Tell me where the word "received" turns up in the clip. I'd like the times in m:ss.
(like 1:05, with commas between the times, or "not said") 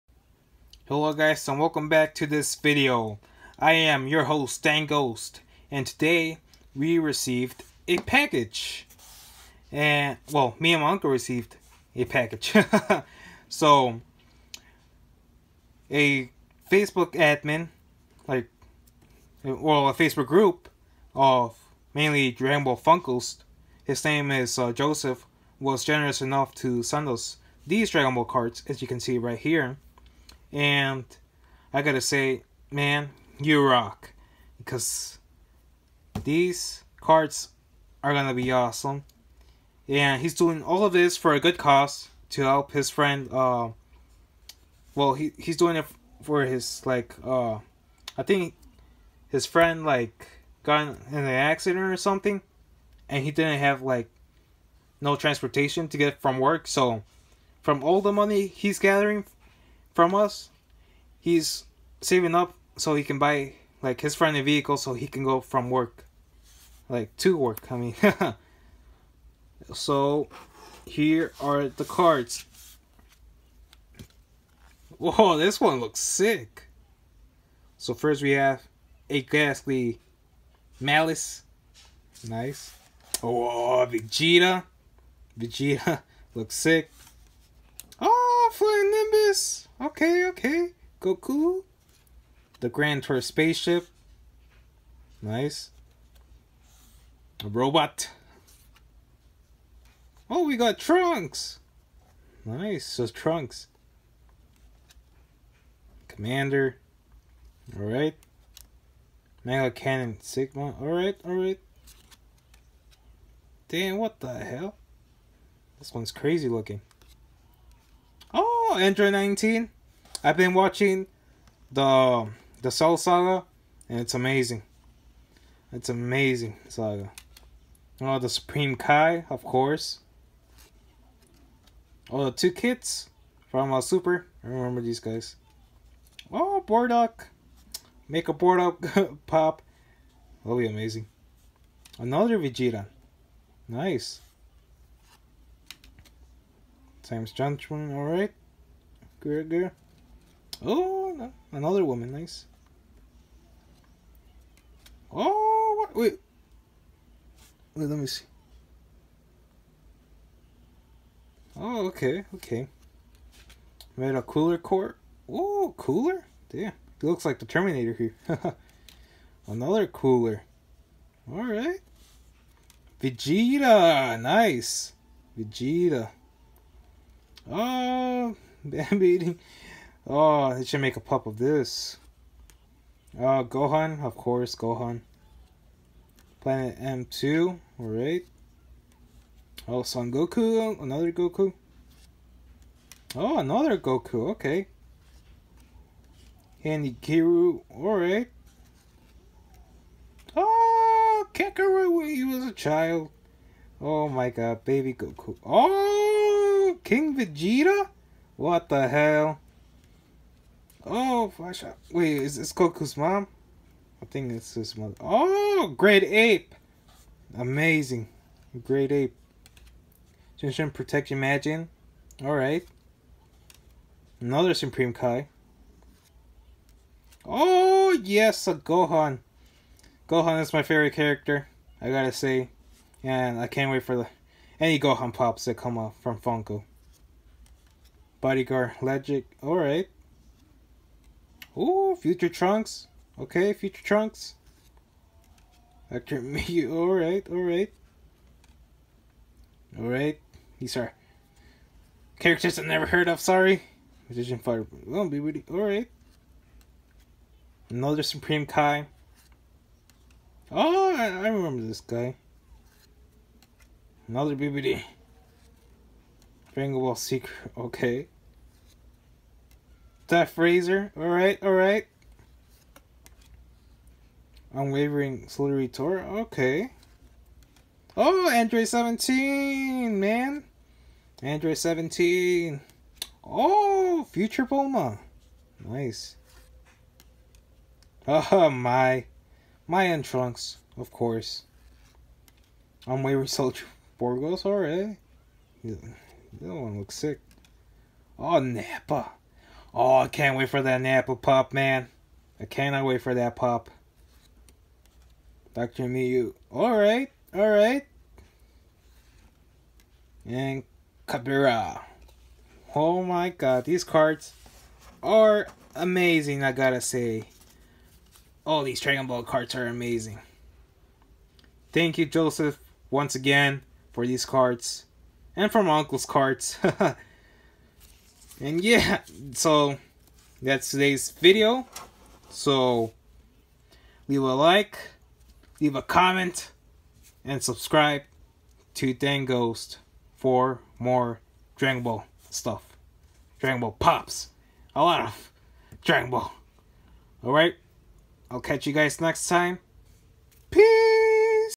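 0:06, 0:11.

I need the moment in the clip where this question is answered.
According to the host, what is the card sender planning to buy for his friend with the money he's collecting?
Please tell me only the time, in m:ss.
1:04.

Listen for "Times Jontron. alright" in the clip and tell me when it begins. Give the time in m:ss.
2:27.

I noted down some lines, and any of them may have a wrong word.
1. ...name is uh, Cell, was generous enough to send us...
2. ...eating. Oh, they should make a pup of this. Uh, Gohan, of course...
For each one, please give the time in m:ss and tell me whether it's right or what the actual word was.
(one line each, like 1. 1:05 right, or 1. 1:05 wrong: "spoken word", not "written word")
1. 0:24 wrong: "Joseph", not "Cell"
2. 2:59 right.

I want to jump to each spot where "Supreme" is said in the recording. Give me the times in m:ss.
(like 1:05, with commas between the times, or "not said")
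2:08, 3:44, 4:18.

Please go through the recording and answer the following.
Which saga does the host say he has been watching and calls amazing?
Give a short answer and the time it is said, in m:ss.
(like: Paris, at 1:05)
The Cell Saga, at 2:02.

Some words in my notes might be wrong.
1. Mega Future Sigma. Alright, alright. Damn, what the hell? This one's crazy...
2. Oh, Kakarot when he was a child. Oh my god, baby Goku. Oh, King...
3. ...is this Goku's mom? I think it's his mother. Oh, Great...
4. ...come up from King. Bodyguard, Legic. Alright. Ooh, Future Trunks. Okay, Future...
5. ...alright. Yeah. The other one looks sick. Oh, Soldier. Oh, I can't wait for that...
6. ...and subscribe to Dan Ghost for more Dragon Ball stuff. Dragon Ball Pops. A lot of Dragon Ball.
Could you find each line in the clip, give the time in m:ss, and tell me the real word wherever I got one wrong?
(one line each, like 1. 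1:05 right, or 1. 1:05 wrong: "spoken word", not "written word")
1. 1:49 wrong: "Cannon", not "Future"
2. 3:20 right
3. 3:32 right
4. 3:55 wrong: "Funko", not "King"
5. 4:54 wrong: "Nappa", not "Soldier"
6. 5:37 right.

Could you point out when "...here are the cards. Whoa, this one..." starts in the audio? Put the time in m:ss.
1:10.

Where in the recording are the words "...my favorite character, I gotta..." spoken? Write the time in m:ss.
3:50.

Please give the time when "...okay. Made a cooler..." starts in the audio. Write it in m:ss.
2:42.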